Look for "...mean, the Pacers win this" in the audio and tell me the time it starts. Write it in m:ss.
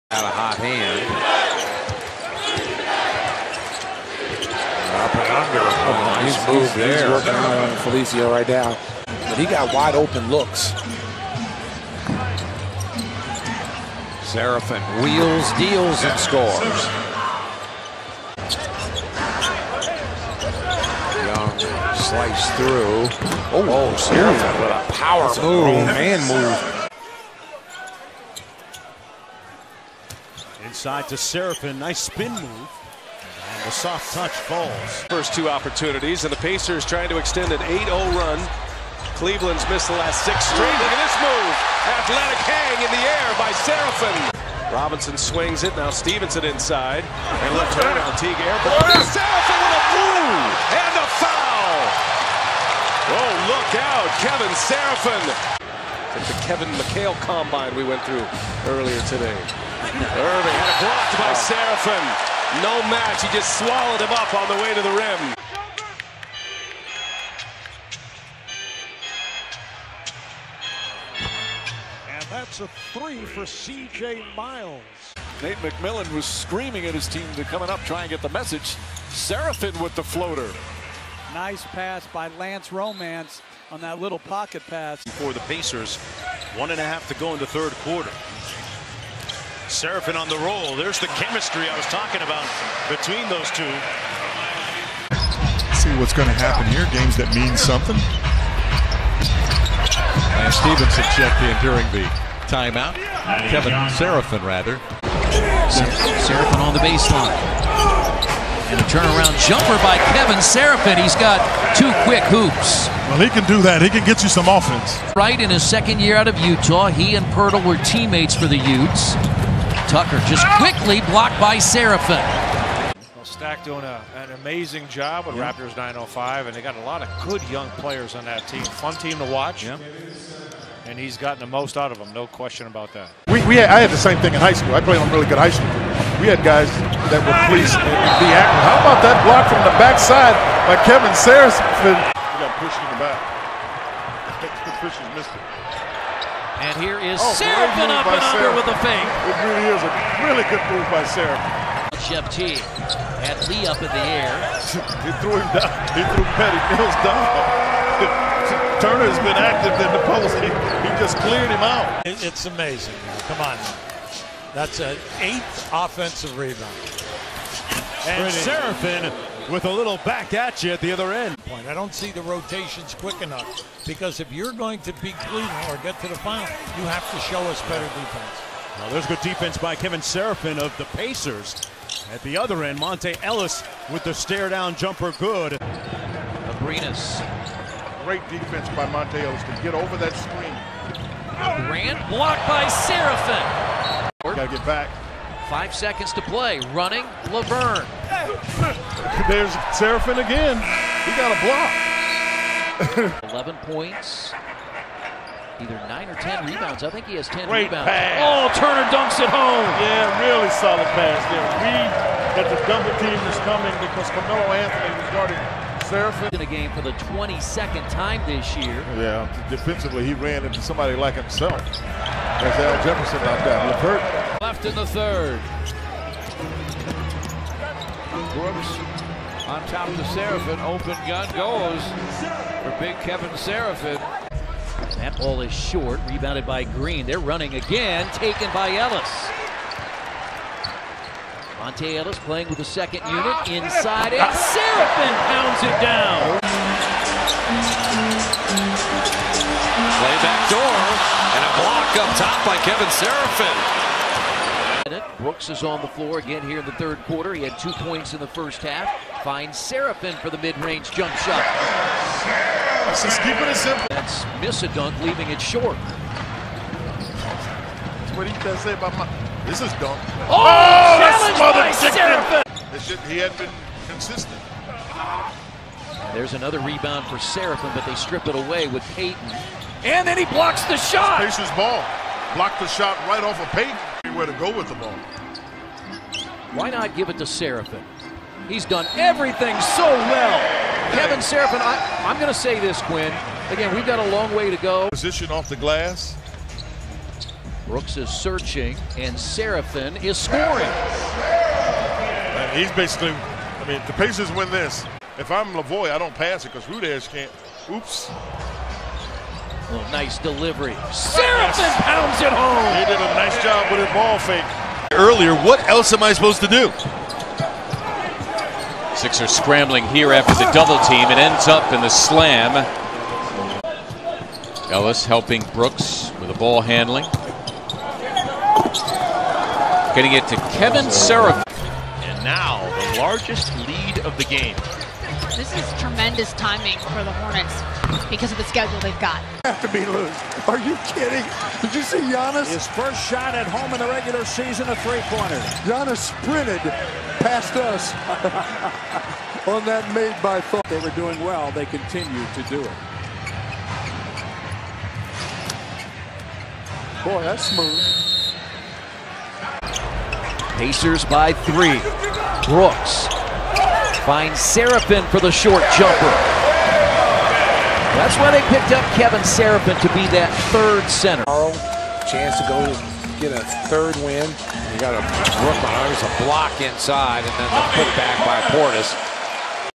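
5:03.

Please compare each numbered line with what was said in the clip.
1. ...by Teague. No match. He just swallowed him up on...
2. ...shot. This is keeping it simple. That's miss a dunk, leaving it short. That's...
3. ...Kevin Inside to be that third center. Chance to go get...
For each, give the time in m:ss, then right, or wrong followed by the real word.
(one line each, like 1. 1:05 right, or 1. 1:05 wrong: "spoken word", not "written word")
1. 1:01 wrong: "Seraphin", not "Teague"
2. 4:21 right
3. 6:08 wrong: "Seraphin", not "Inside".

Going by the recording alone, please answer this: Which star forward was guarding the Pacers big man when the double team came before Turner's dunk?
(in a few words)
Carmelo Anthony.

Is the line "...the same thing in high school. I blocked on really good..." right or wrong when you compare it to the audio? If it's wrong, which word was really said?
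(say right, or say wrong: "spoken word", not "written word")
wrong: "played", not "blocked".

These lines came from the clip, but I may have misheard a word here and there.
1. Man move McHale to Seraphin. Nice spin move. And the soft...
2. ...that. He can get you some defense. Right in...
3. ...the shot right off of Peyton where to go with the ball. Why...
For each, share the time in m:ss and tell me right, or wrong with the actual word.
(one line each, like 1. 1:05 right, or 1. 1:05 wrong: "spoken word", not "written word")
1. 0:25 wrong: "Inside", not "McHale"
2. 1:53 wrong: "offense", not "defense"
3. 4:42 right.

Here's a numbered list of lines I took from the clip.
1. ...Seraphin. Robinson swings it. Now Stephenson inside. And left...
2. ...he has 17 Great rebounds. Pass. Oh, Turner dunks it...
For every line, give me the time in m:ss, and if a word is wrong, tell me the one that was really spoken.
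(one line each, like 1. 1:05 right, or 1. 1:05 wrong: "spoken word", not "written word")
1. 0:43 right
2. 3:27 wrong: "10", not "17".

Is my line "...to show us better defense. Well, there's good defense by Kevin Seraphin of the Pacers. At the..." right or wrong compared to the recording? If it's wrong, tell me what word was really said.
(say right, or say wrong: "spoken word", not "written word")
right.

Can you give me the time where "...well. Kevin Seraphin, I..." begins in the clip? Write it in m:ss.
4:49.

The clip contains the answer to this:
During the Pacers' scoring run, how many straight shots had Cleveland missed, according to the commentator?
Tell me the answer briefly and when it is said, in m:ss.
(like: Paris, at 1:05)
6, at 0:40.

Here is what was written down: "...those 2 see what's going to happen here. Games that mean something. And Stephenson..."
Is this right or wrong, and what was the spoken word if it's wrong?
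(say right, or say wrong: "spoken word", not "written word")
right.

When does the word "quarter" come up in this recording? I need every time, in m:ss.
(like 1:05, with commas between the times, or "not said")
1:27, 4:17.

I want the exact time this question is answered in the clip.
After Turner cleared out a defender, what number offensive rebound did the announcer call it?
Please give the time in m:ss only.
2:45.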